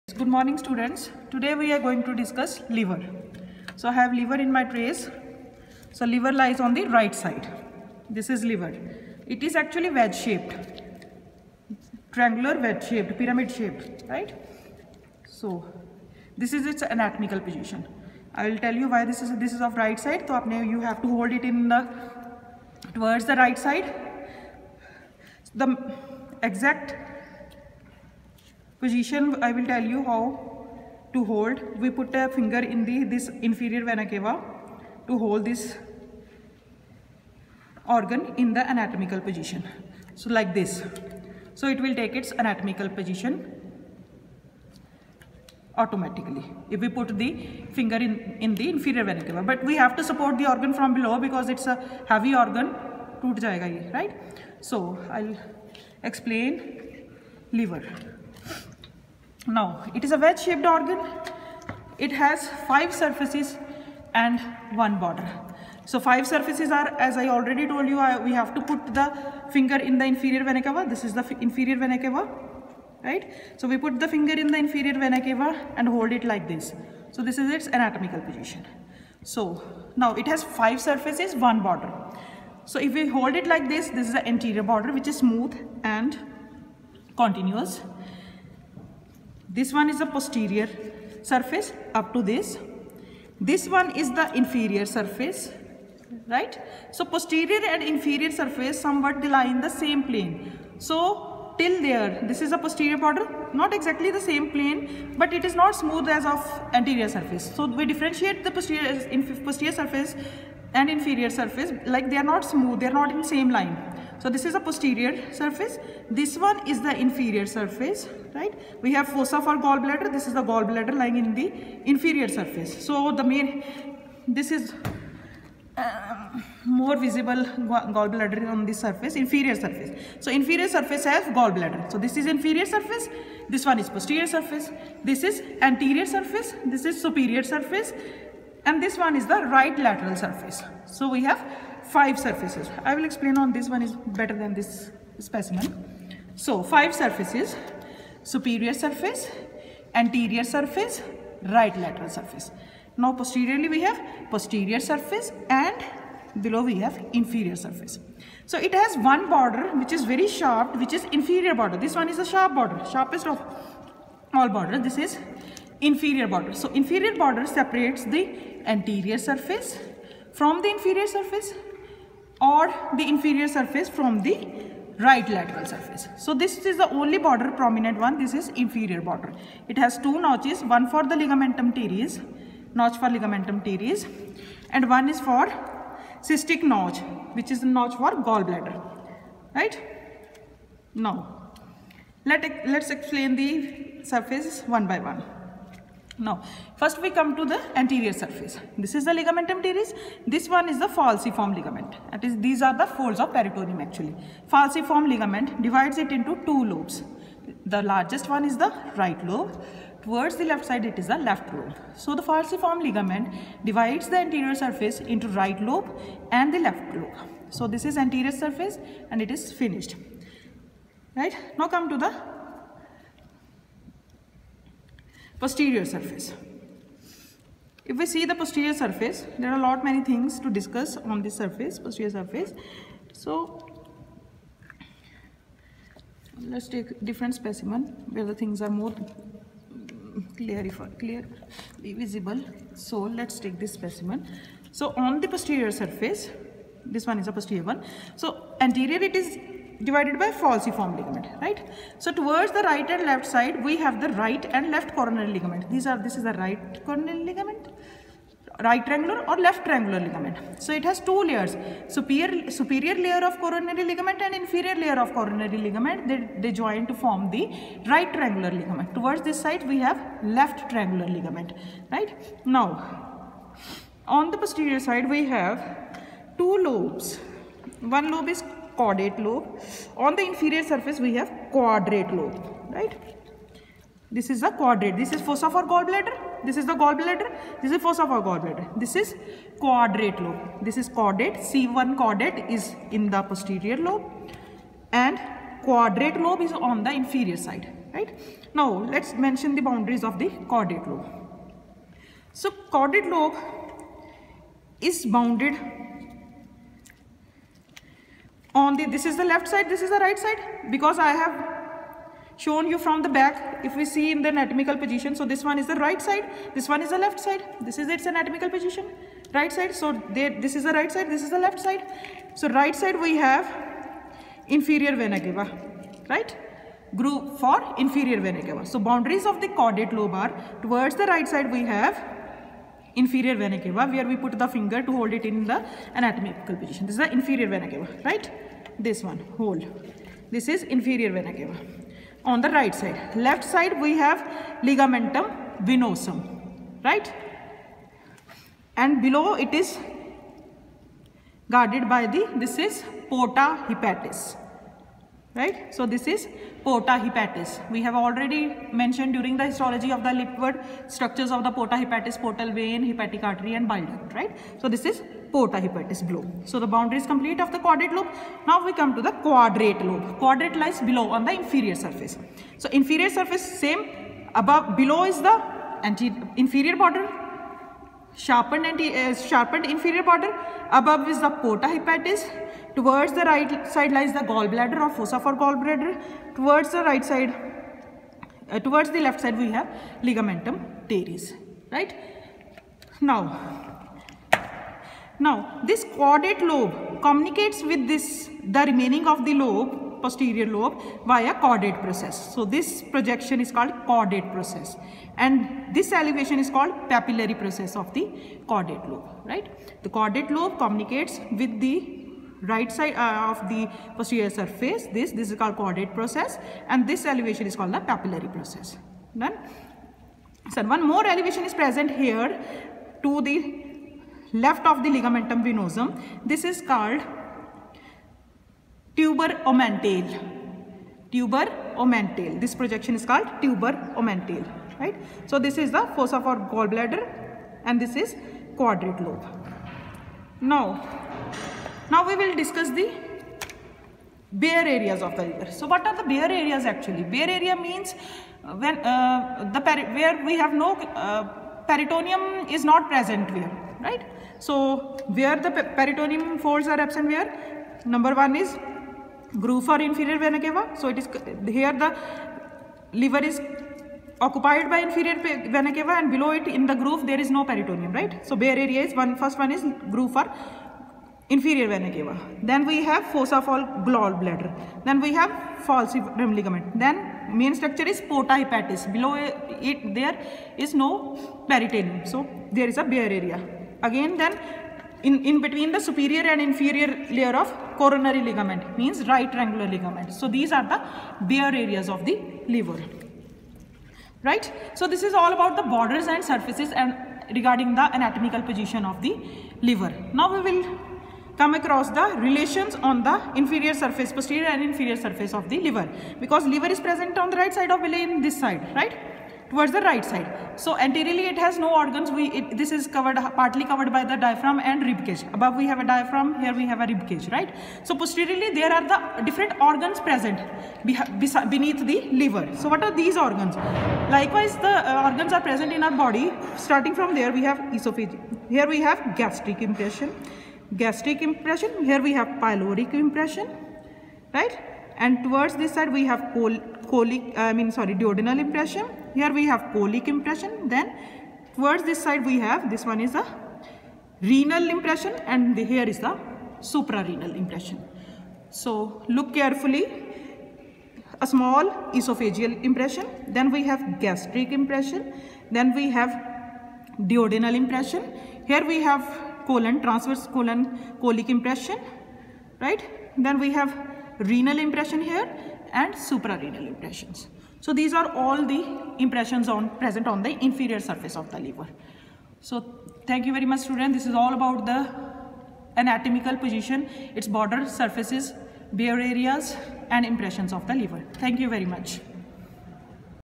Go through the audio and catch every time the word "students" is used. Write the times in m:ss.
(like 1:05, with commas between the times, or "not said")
0:00, 9:33.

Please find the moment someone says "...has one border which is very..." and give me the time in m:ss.
2:38.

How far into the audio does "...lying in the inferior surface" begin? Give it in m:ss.
2:00.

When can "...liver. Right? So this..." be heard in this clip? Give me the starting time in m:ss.
8:12.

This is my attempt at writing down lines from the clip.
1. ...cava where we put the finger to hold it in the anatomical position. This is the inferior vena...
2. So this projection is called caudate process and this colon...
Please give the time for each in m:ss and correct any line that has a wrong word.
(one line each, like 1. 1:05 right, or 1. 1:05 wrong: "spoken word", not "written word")
1. 5:33 right
2. 6:42 wrong: "elevation", not "colon".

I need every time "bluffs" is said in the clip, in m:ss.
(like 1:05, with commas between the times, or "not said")
not said.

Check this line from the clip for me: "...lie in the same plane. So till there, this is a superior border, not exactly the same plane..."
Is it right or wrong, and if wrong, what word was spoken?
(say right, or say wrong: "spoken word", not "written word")
wrong: "posterior", not "superior".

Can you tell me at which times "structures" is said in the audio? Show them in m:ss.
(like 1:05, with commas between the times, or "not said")
6:00, 7:57.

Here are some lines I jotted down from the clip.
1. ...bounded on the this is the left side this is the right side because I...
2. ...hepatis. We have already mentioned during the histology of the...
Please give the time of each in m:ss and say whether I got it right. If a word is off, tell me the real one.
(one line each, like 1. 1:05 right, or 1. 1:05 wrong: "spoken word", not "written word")
1. 5:05 right
2. 5:56 right.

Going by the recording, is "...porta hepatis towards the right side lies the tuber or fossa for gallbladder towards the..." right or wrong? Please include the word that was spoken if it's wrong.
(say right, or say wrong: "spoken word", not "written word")
wrong: "gallbladder", not "tuber".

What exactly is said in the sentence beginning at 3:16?
Now, first we come to the anterior surface.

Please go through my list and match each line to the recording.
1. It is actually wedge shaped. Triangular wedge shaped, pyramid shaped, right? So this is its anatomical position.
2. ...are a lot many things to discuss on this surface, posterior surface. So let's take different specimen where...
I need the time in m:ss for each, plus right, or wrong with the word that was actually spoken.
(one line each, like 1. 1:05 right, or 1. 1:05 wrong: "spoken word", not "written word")
1. 0:09 right
2. 3:49 right.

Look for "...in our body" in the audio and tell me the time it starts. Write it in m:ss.
8:45.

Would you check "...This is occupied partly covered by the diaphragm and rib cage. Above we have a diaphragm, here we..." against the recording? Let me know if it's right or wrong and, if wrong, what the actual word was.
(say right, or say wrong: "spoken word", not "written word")
wrong: "covered", not "occupied".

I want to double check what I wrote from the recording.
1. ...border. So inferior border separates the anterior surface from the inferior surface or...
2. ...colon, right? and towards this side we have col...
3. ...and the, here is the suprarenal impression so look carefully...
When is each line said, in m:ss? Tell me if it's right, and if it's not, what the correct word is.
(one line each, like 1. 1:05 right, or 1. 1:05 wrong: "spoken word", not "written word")
1. 2:46 right
2. 8:52 wrong: "impression", not "colon"
3. 9:05 right.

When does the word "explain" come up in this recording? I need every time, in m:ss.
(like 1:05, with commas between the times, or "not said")
0:56, 2:23, 3:12.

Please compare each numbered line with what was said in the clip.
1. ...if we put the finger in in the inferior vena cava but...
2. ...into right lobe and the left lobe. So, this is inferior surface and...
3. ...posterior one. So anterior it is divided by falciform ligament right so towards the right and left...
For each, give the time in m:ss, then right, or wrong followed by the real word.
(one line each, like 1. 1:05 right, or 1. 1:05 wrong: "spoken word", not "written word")
1. 0:46 right
2. 3:34 wrong: "anterior", not "inferior"
3. 4:07 right.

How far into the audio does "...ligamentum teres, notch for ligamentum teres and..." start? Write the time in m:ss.
3:01.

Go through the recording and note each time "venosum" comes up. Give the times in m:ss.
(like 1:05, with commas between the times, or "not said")
5:45, 7:05.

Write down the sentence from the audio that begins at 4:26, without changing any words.
They, they join to form the right triangular ligament.